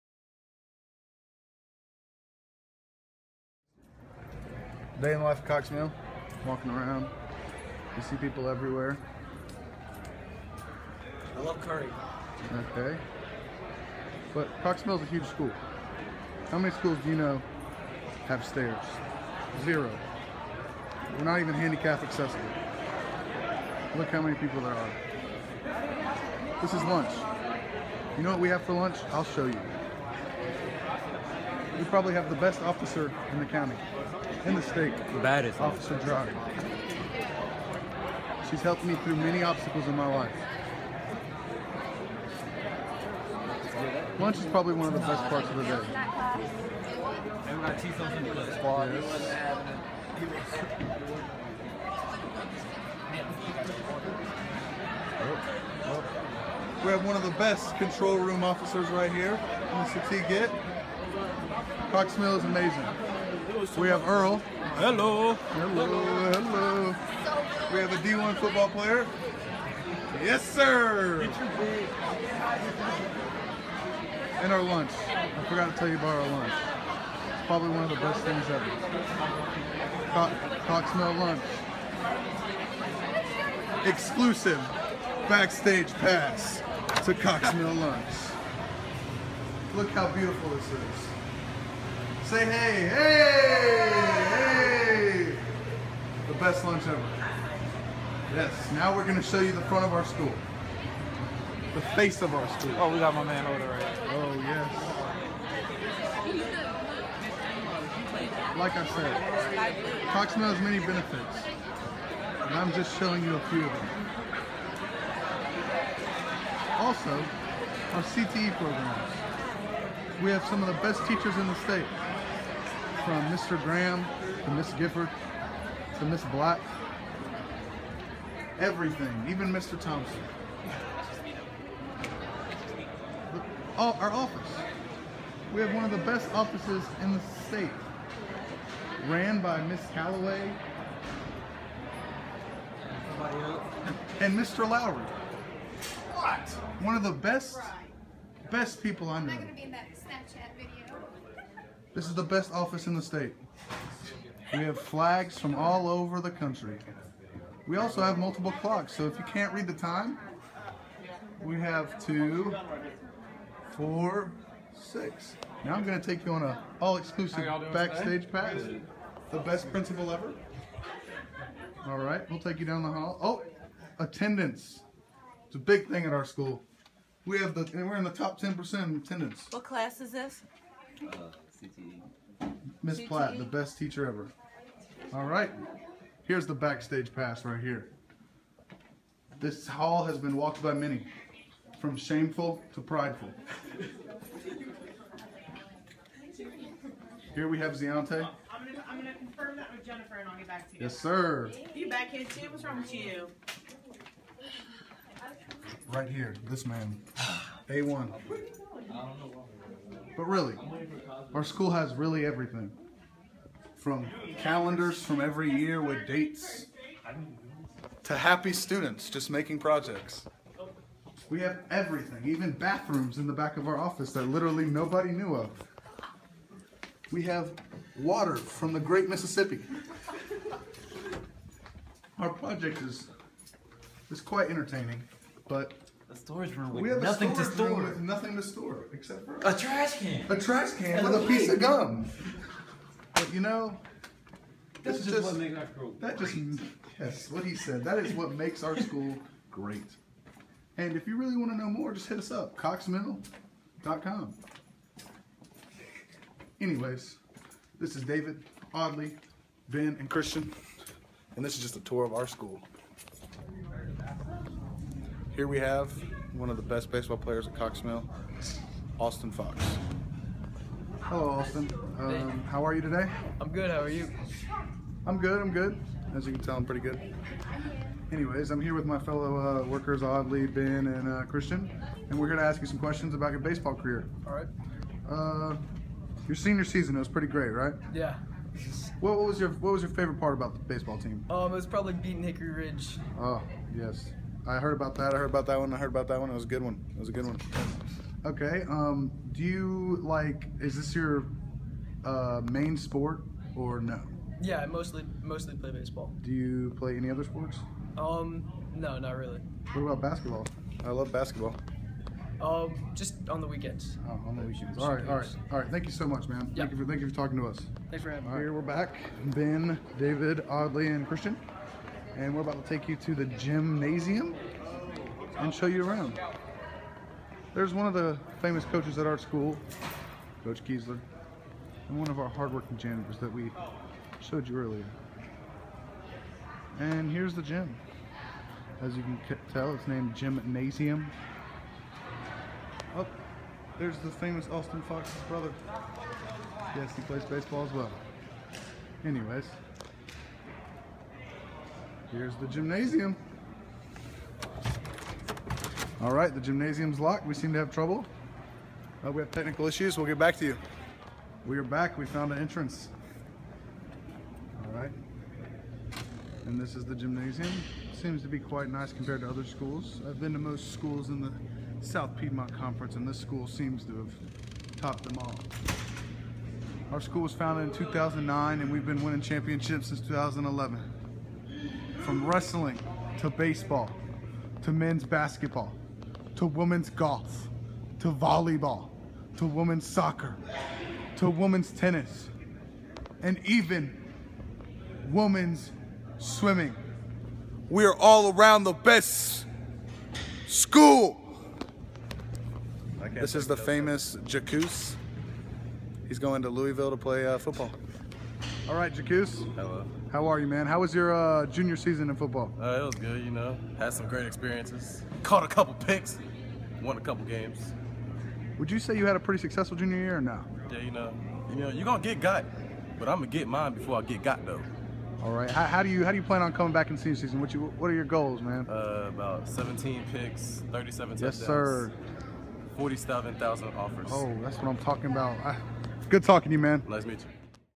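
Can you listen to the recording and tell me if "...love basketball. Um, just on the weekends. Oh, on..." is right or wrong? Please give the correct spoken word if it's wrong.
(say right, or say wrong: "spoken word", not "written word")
right.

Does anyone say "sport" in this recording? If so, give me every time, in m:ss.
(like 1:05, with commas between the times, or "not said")
5:02, 5:07.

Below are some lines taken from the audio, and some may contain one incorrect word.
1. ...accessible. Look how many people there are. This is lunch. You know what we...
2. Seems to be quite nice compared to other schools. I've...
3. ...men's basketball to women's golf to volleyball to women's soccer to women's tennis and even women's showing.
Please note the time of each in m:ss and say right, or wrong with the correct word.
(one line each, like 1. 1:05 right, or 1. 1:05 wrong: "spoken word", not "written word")
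1. 0:22 right
2. 6:07 right
3. 6:24 wrong: "swimming", not "showing".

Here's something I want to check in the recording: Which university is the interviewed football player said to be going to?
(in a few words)
Louisville.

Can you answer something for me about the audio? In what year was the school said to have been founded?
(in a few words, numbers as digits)
2009.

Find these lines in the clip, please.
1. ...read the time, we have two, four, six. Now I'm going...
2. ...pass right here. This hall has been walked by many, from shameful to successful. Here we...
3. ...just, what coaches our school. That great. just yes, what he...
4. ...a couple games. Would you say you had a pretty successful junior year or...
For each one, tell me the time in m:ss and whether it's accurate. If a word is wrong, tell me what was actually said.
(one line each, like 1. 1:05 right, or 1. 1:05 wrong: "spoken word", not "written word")
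1. 2:39 right
2. 3:07 wrong: "prideful", not "successful"
3. 4:05 wrong: "makes", not "coaches"
4. 6:56 right.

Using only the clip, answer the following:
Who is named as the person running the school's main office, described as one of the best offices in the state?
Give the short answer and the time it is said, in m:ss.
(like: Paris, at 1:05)
Miss Calloway, at 2:19.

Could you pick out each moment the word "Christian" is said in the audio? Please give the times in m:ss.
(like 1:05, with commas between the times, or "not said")
4:20, 4:41, 5:21.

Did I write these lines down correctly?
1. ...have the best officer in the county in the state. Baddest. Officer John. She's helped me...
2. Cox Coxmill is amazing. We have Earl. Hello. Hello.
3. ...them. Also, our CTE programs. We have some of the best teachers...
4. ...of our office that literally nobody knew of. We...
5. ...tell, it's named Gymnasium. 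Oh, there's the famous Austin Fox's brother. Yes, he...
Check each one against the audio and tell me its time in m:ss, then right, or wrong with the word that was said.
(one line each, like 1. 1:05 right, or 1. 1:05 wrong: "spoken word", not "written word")
1. 0:32 right
2. 1:01 right
3. 1:53 right
4. 3:43 right
5. 5:39 right.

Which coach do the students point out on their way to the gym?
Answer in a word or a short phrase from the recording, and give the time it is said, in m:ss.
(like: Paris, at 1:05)
Coach Kiesler, at 5:30.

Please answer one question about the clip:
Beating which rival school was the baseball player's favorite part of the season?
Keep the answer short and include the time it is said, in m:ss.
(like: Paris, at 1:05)
Hickory Ridge, at 4:52.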